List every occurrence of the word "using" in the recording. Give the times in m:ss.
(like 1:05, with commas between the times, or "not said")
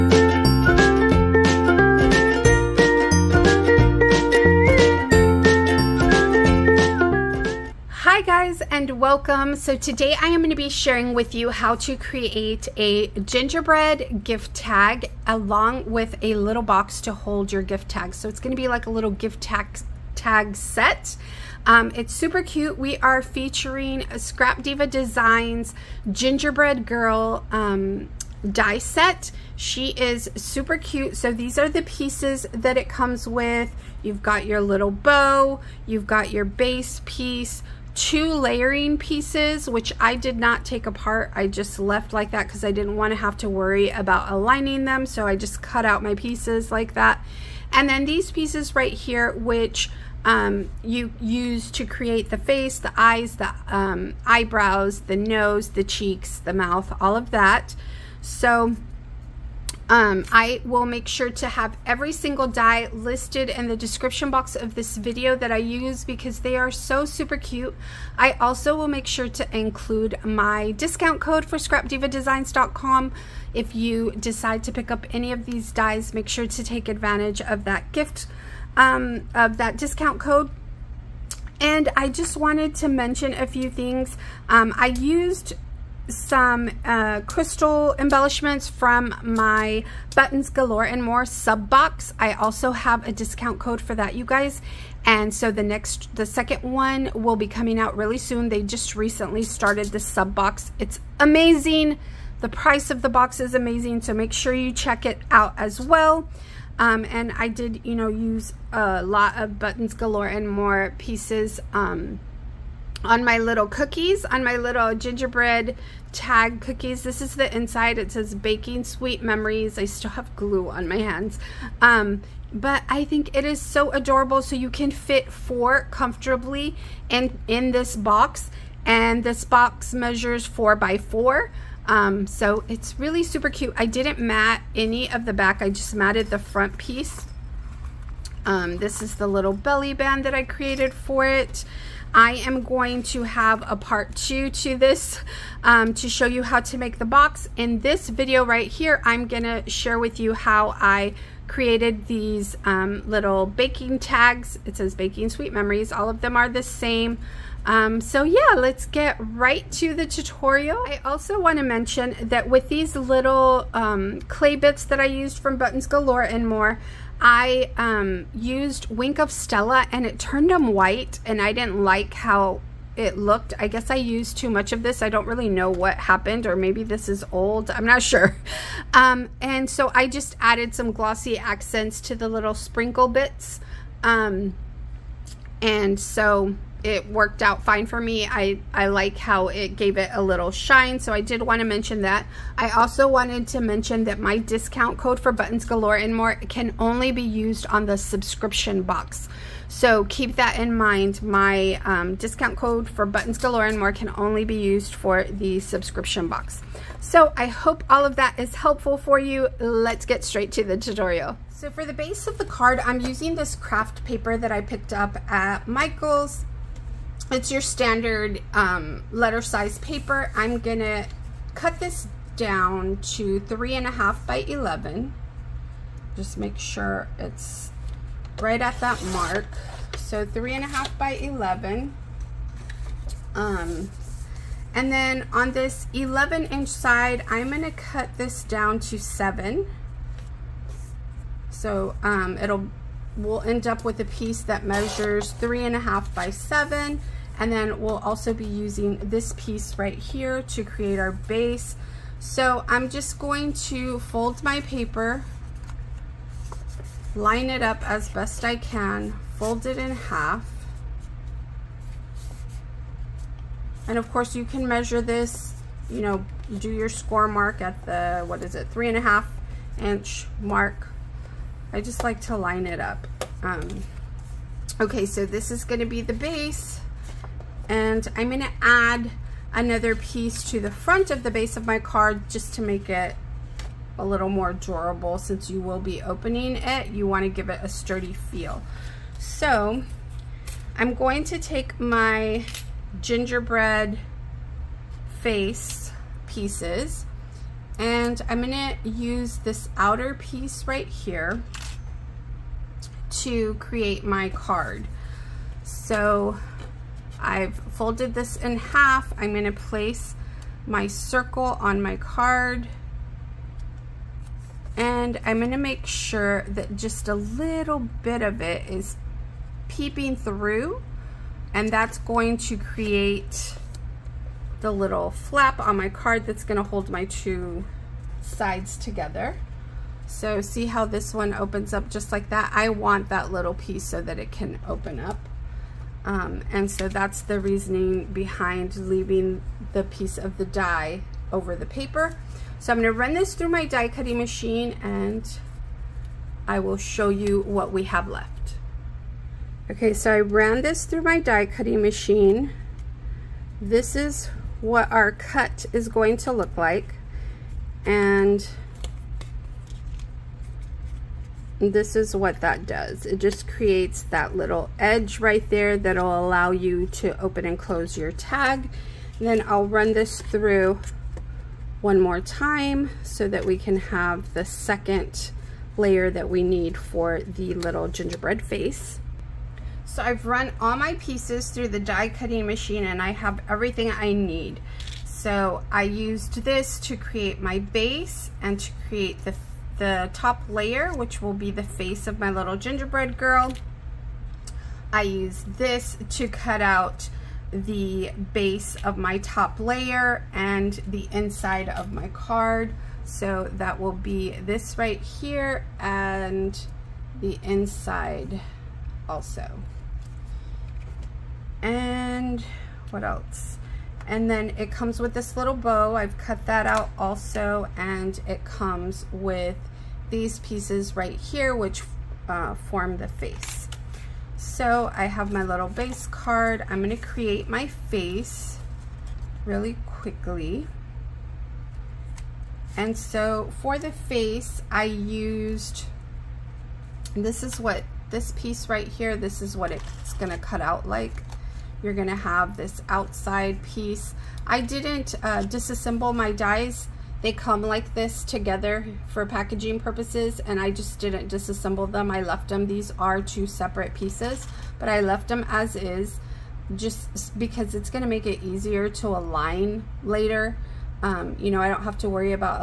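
3:33, 4:08.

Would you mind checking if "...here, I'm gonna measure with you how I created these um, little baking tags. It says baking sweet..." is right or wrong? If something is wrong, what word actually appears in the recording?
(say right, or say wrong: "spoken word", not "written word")
wrong: "share", not "measure".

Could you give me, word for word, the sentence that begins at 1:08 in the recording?
I also will make sure to include my discount code for scrapdivadesigns.com.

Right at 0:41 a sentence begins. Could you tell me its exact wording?
I just left like that because I didn't want to have to worry about aligning them.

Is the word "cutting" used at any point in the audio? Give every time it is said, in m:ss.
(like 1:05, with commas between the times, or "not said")
5:43, 5:51, 6:22.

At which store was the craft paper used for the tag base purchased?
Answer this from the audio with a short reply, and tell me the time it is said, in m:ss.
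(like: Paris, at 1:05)
Michael's, at 3:35.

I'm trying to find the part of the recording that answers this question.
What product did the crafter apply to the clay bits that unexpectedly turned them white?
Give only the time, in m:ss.
2:48.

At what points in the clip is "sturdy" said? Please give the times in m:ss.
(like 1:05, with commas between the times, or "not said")
4:47.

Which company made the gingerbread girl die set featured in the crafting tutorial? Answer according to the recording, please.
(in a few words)
Scrap Diva Designs.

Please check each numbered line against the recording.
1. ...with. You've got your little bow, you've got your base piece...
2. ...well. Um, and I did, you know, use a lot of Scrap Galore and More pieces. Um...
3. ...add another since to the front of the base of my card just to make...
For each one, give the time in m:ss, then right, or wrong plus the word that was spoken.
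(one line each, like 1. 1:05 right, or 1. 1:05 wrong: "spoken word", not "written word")
1. 0:33 right
2. 1:45 wrong: "Buttons", not "Scrap"
3. 4:38 wrong: "piece", not "since".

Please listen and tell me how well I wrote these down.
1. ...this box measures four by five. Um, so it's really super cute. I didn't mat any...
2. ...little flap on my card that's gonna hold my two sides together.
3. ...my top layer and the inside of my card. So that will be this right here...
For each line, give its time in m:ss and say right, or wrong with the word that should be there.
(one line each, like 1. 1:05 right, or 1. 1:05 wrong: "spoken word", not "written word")
1. 2:09 wrong: "four", not "five"
2. 5:24 right
3. 6:38 right.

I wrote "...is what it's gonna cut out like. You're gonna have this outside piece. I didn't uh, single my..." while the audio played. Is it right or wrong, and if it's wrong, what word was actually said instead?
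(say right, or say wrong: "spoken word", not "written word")
wrong: "disassemble", not "single".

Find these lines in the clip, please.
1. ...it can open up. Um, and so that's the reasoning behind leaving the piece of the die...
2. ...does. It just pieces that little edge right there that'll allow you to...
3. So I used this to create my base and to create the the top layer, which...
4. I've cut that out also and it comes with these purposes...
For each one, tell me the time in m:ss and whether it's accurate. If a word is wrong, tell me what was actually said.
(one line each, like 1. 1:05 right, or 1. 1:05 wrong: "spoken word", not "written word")
1. 5:34 right
2. 6:02 wrong: "creates", not "pieces"
3. 6:25 right
4. 6:55 wrong: "pieces", not "purposes".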